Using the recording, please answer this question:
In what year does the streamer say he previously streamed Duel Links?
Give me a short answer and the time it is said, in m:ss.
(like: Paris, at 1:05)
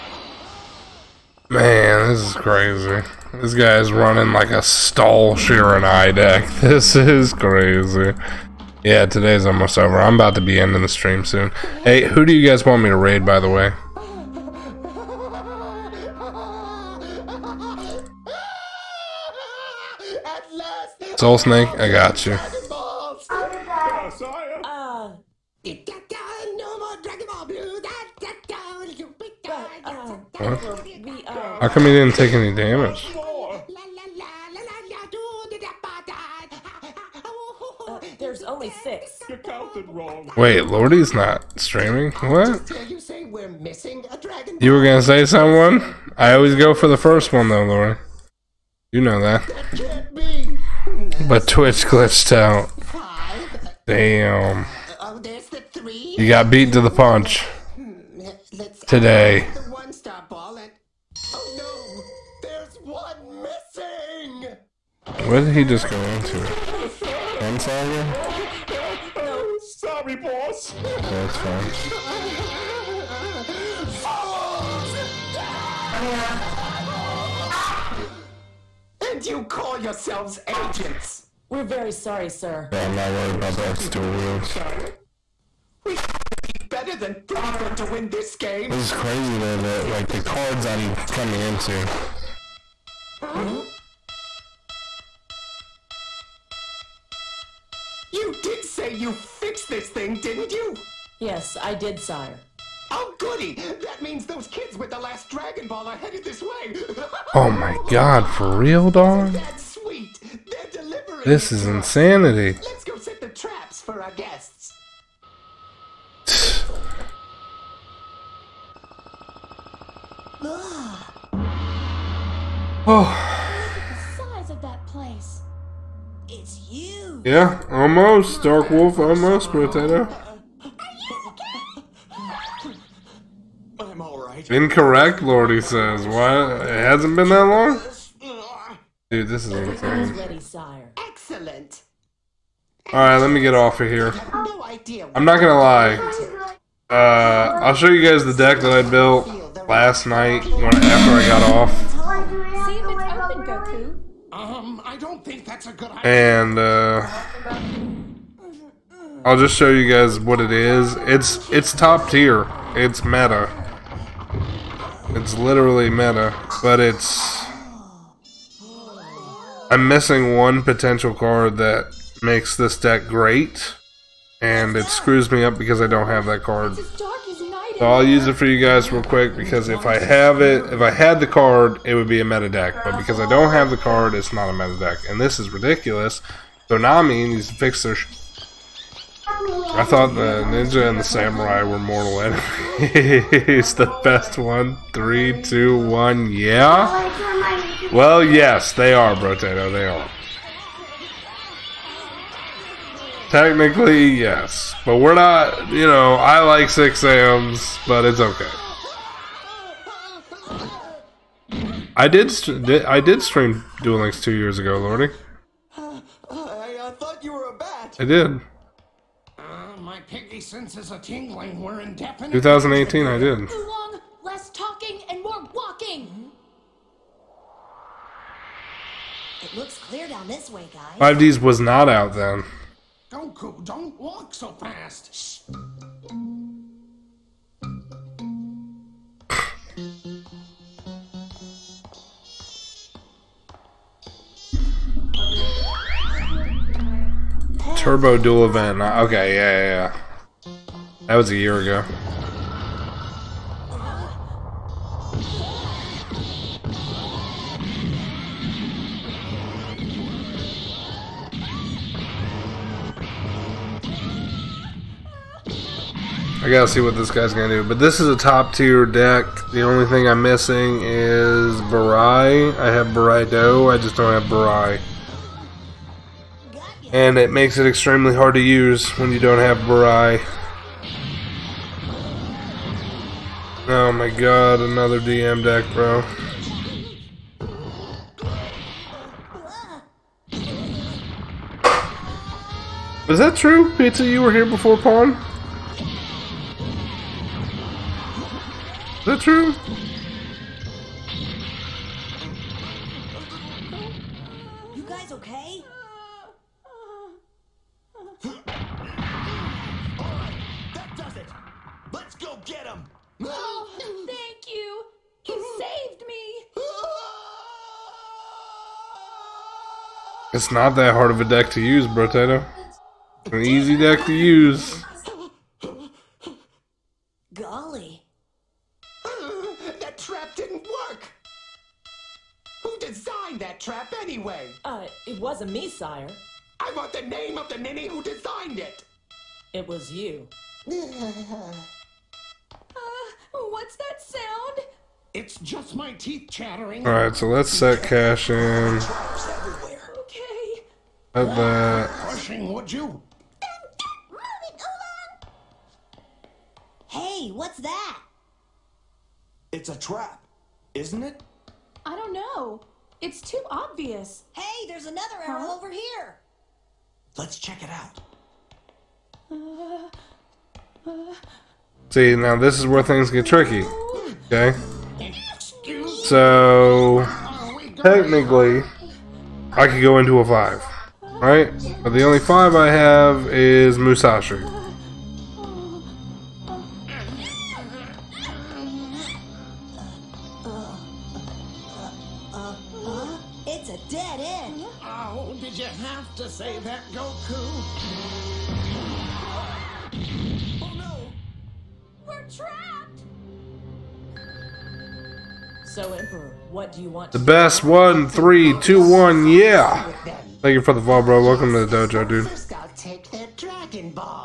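2018, at 3:42.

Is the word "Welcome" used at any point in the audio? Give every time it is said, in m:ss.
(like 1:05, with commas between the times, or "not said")
6:51.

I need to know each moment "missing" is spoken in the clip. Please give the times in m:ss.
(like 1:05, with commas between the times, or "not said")
2:49, 4:30.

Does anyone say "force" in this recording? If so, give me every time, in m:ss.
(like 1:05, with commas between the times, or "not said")
not said.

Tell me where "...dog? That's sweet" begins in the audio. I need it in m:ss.
1:48.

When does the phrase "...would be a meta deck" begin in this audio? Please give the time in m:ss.
3:01.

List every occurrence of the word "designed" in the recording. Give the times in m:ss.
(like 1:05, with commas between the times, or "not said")
5:32, 5:38.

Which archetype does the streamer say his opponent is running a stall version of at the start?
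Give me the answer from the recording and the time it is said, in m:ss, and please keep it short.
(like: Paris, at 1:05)
Shiranui, at 0:05.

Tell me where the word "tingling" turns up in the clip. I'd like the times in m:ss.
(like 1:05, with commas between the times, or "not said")
3:40.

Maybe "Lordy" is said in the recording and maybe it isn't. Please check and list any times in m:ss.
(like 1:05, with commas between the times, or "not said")
0:40, 2:15, 3:34.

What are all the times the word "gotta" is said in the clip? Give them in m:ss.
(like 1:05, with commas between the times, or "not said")
4:26.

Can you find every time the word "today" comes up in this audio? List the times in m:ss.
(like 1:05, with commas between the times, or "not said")
0:09, 0:58.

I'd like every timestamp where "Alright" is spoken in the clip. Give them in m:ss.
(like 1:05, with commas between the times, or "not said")
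2:22, 5:46.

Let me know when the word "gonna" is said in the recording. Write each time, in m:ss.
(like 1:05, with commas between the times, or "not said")
0:44, 2:25, 4:27.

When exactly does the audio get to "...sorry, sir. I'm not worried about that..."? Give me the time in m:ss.
1:21.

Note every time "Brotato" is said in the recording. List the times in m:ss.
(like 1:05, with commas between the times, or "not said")
3:19, 5:21.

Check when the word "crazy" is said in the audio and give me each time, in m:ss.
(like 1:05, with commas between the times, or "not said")
0:02, 0:07, 1:28.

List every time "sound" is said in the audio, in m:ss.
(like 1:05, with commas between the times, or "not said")
5:44.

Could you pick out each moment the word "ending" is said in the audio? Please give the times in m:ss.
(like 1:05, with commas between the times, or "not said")
0:10.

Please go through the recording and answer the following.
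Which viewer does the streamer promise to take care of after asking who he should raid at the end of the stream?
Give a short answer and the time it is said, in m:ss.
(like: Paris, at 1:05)
Soul Snake, at 0:21.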